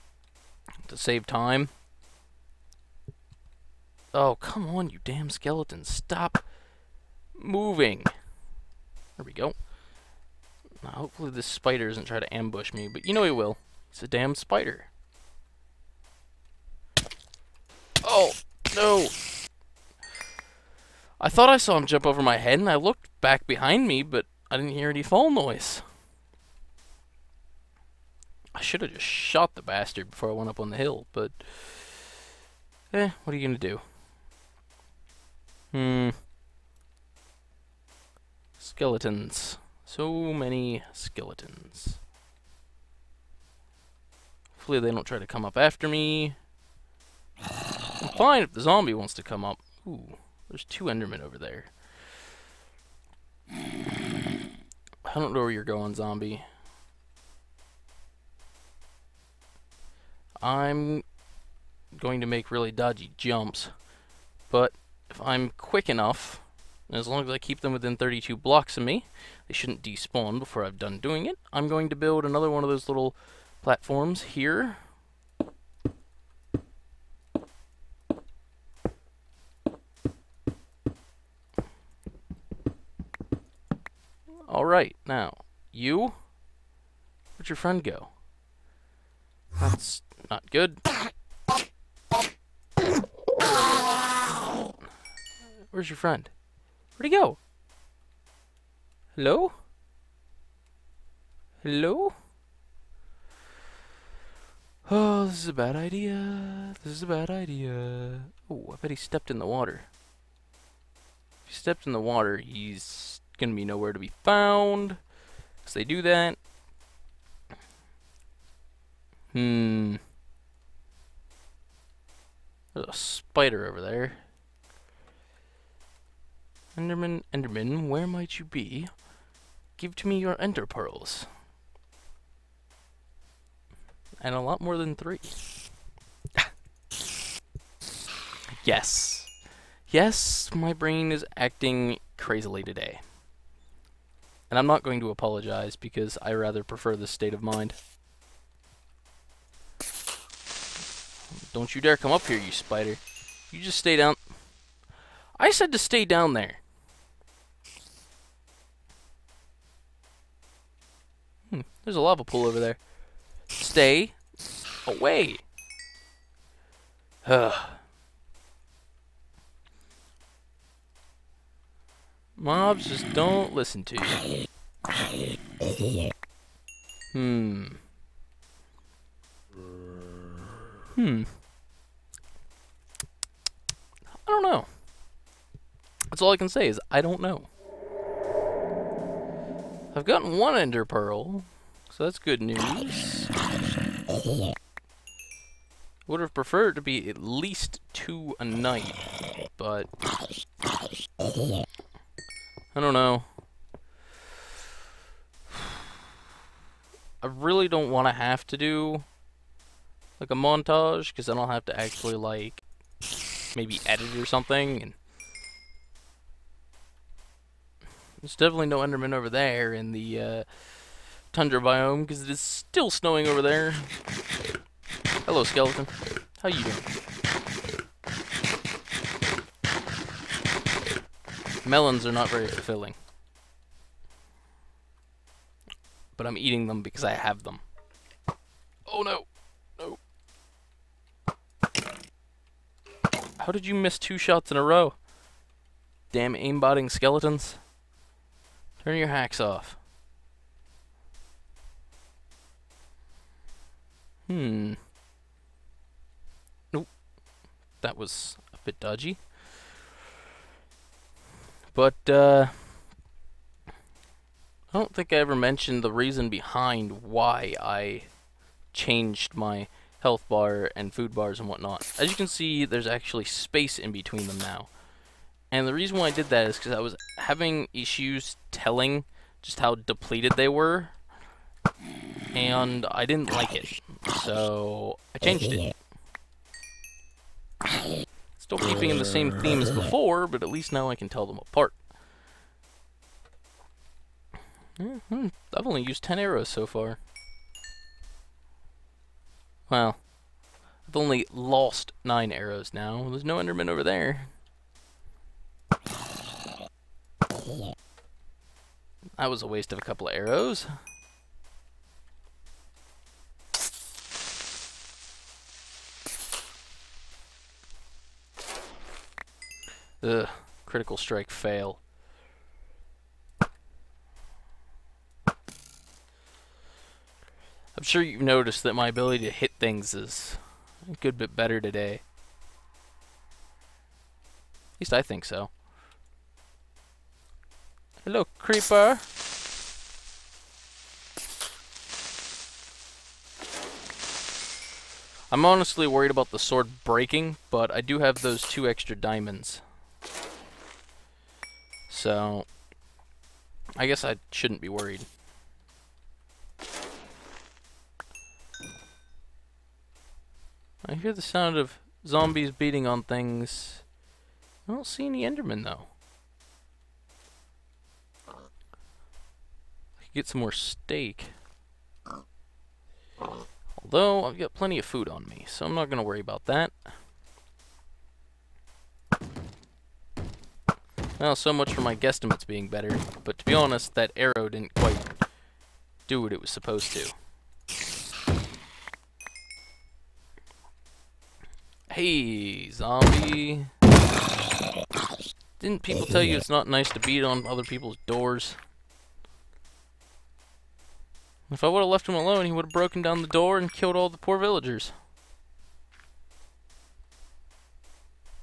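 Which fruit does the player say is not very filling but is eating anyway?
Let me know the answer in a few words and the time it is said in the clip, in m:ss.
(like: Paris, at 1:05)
Melons, at 3:51.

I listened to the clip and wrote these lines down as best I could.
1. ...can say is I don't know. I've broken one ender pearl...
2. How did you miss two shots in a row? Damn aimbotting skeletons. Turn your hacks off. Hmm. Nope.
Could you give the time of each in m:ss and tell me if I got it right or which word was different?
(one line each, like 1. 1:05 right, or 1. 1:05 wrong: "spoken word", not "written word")
1. 3:06 wrong: "gotten", not "broken"
2. 4:03 right.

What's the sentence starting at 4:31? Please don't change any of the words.
As you can see, there's actually space in between them now.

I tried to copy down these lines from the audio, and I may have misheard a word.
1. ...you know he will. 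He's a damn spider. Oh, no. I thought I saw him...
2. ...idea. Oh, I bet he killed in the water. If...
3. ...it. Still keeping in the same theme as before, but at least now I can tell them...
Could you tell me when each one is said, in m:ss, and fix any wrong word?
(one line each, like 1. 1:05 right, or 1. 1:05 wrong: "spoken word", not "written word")
1. 0:13 right
2. 1:47 wrong: "stepped", not "killed"
3. 4:45 right.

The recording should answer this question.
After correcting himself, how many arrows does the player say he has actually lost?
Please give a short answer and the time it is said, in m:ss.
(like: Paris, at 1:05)
9, at 5:02.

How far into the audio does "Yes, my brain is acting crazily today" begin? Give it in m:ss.
2:19.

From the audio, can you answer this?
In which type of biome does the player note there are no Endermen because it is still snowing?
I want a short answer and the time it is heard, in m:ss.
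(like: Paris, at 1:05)
tundra, at 3:41.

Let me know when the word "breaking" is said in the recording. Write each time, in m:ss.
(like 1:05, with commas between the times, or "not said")
5:46.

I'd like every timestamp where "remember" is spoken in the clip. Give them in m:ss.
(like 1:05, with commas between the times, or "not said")
not said.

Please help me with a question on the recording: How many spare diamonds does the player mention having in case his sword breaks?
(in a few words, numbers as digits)
2.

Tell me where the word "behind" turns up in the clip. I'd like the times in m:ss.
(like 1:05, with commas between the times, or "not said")
0:23, 4:26.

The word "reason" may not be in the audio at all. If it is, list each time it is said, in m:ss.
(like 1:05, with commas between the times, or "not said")
4:25, 4:35.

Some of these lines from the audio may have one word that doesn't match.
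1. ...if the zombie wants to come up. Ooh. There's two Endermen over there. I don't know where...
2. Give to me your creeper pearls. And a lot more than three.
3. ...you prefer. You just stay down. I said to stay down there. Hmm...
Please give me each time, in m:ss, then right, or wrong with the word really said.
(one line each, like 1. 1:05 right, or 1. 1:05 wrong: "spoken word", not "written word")
1. 0:48 right
2. 2:09 wrong: "ender", not "creeper"
3. 2:32 wrong: "spider", not "prefer".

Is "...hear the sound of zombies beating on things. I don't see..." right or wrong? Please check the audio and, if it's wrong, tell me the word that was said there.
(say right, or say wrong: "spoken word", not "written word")
right.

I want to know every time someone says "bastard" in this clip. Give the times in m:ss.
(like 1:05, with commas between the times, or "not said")
0:29.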